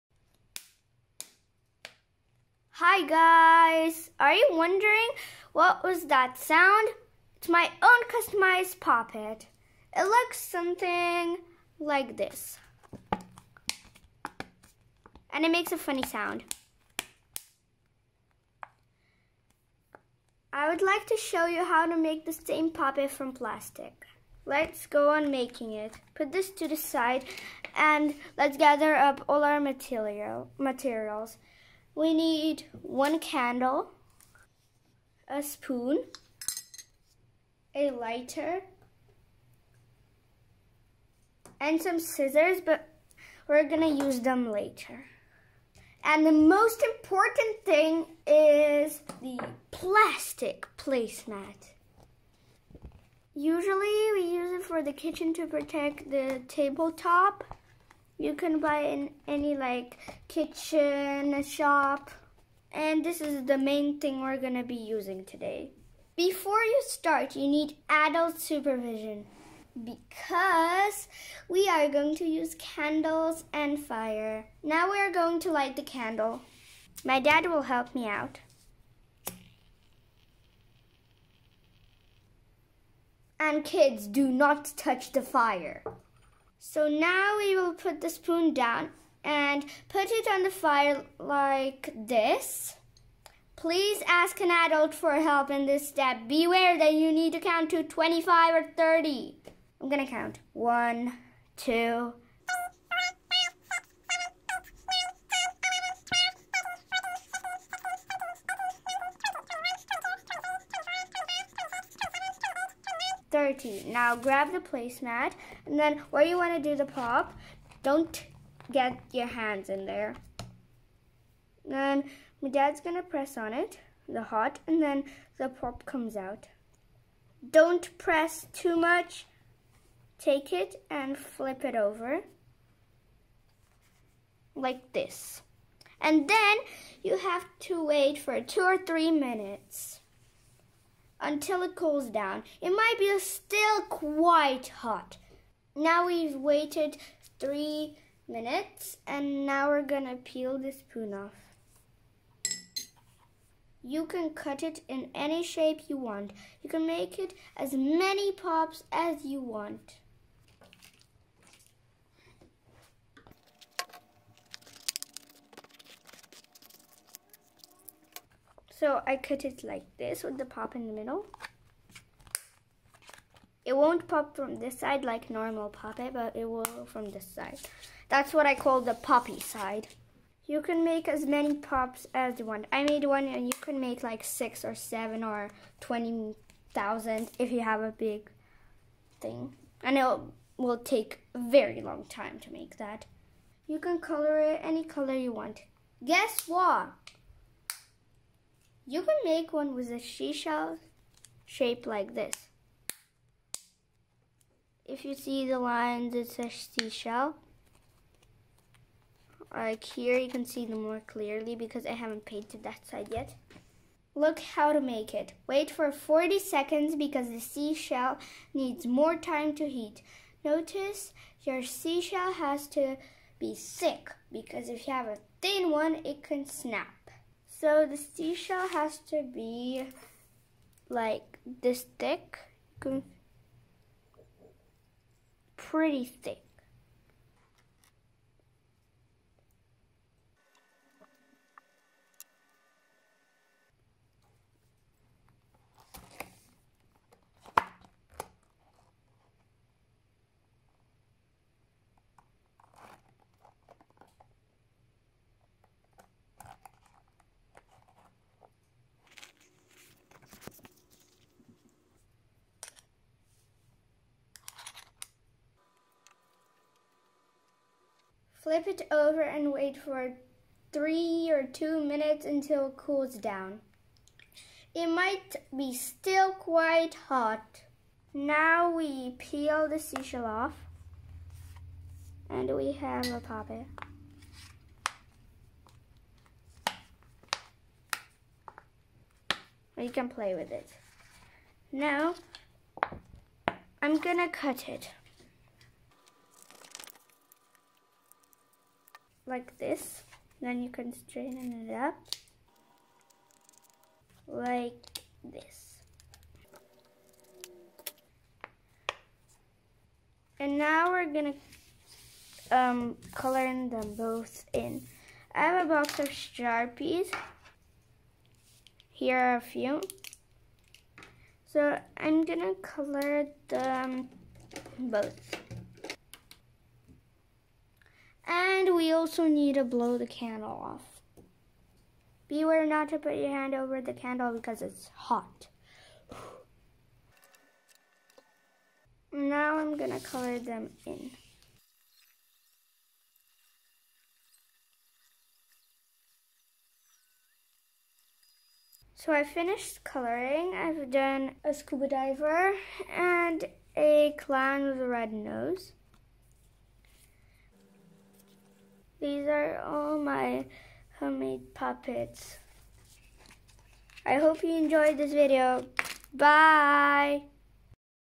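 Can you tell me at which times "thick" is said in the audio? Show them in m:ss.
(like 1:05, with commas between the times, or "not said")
3:43, 3:51, 3:56.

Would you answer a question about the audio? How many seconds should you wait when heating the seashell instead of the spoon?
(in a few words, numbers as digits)
40.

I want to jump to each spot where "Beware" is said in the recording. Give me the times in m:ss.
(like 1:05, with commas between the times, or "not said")
1:36, 5:32.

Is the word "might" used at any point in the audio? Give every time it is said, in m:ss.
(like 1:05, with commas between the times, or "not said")
2:22, 4:34.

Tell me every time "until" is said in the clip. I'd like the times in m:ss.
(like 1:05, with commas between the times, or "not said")
2:21, 4:32.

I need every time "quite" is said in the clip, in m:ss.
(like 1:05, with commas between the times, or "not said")
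2:23, 4:36.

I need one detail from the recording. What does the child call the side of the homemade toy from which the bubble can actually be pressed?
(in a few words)
the poppy side.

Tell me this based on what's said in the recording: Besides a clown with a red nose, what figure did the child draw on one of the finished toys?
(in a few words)
a scuba diver.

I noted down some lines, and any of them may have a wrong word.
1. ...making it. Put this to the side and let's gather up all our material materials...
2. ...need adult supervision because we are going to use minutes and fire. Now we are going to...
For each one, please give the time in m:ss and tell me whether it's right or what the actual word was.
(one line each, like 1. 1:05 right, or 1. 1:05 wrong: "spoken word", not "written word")
1. 0:25 right
2. 1:07 wrong: "candles", not "minutes".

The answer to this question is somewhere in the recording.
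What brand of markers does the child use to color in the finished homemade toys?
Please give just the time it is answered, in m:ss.
5:16.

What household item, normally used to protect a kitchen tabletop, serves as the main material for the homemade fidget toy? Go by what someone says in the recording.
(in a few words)
plastic placemat.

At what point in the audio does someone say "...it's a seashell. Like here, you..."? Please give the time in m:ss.
3:26.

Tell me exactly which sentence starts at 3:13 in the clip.
You can color it any color you want.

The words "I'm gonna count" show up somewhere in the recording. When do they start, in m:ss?
1:39.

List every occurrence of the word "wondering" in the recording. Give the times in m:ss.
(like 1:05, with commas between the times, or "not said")
0:04.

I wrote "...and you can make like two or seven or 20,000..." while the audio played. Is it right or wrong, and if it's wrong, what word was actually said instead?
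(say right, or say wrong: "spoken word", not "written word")
wrong: "six", not "two".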